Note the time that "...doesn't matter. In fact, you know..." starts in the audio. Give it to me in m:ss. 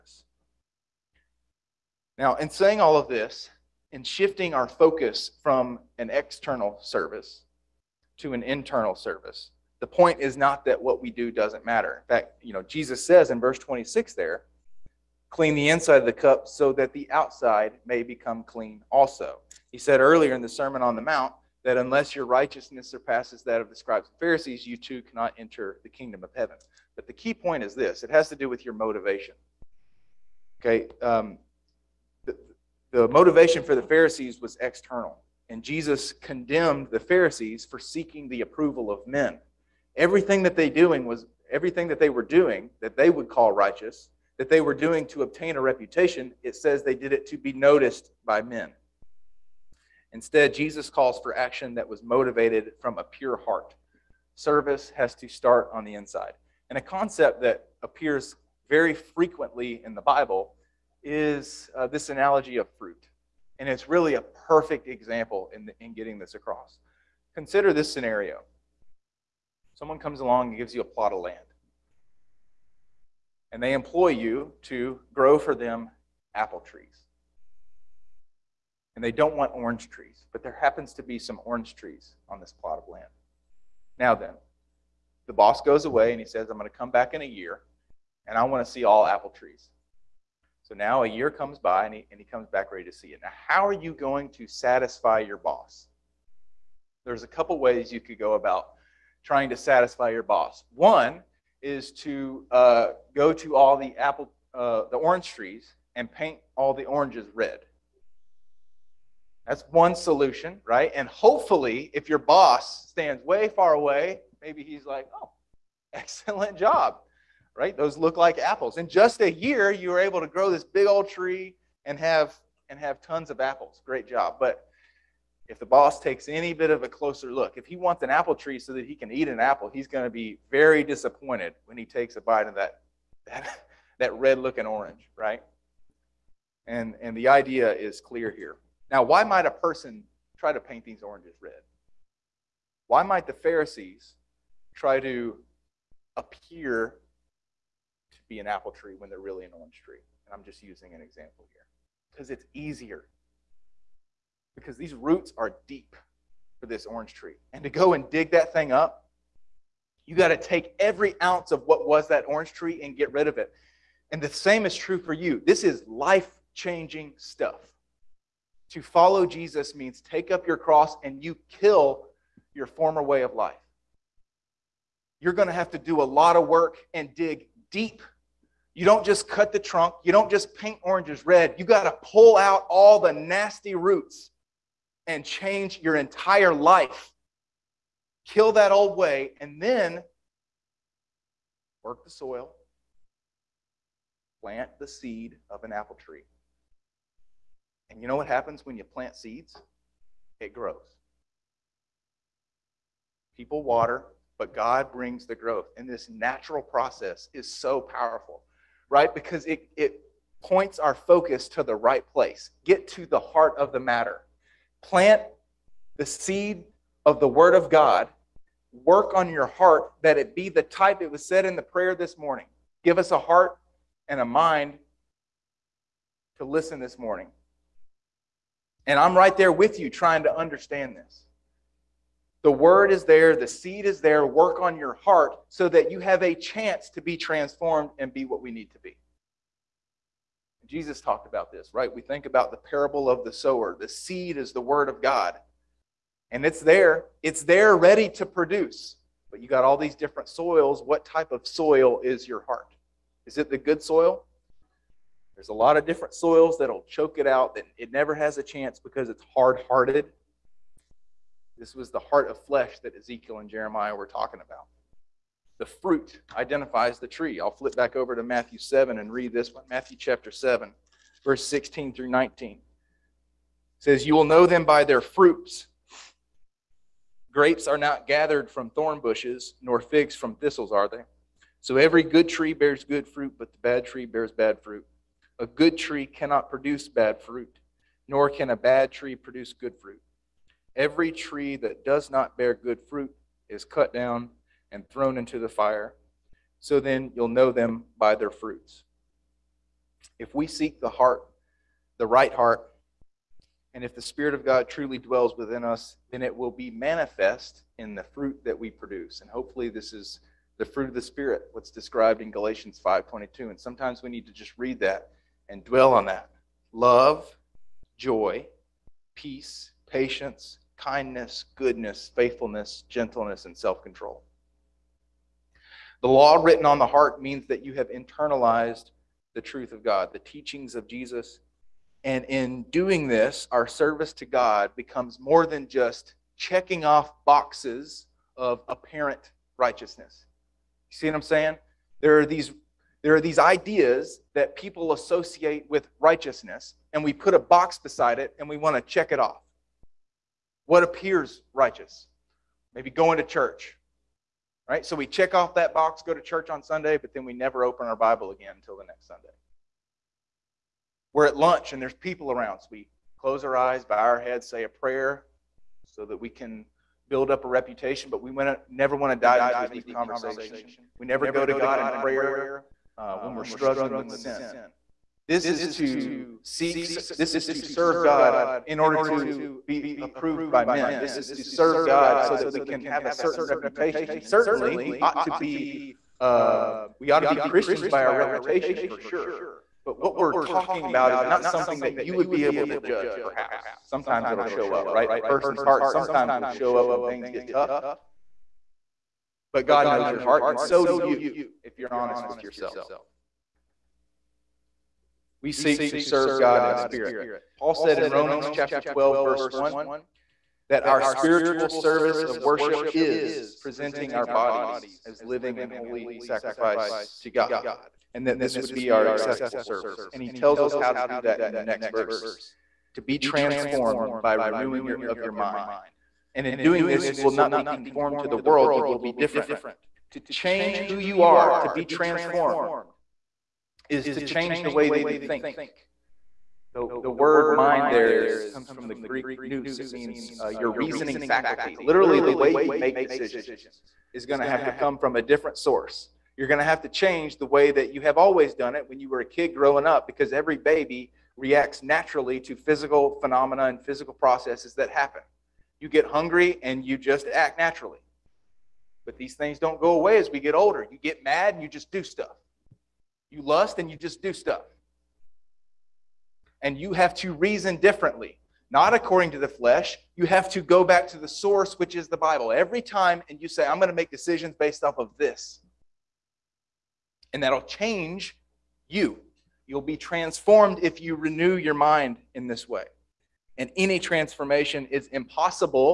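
0:11.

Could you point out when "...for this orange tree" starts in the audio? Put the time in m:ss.
2:36.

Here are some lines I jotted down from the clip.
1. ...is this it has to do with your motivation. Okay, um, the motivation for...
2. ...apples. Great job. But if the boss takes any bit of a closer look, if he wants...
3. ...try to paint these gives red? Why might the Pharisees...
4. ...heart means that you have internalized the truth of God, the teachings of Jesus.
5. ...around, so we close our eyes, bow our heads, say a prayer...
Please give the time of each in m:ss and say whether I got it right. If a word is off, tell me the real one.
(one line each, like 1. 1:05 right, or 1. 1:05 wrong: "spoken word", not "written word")
1. 0:27 right
2. 2:03 right
3. 2:20 wrong: "oranges", not "gives"
4. 5:26 right
5. 6:02 right.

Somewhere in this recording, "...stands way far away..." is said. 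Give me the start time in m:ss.
1:52.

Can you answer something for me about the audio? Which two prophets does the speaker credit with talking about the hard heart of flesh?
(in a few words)
Ezekiel and Jeremiah.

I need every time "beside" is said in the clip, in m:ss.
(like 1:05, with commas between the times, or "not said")
5:47.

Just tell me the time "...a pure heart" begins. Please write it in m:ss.
0:52.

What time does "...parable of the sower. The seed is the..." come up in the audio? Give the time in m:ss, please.
4:02.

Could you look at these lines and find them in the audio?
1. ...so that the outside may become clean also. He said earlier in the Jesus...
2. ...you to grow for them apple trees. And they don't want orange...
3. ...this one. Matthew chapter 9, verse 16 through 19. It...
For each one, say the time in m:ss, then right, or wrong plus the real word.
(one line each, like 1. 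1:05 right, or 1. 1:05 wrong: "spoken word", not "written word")
1. 0:16 wrong: "Sermon", not "Jesus"
2. 1:14 right
3. 4:29 wrong: "7", not "9".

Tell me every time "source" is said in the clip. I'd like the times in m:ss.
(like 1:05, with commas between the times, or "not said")
7:25, 7:51.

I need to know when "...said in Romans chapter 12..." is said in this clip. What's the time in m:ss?
6:47.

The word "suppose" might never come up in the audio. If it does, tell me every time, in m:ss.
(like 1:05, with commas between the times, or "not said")
not said.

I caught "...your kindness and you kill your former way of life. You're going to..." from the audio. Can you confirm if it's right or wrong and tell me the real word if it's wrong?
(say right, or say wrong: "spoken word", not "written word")
wrong: "cross", not "kindness".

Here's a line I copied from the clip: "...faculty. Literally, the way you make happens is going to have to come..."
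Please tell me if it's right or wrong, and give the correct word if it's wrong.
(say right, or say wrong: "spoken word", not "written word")
wrong: "decisions", not "happens".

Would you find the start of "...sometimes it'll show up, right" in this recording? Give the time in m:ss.
6:33.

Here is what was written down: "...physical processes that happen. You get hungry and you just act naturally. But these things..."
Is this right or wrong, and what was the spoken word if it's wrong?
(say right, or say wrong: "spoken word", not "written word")
right.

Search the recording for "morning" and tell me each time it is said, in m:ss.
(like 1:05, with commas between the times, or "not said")
3:42, 3:46.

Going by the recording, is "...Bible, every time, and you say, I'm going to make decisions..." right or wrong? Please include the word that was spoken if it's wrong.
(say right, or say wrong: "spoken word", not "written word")
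right.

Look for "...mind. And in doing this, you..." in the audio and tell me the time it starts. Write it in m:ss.
7:05.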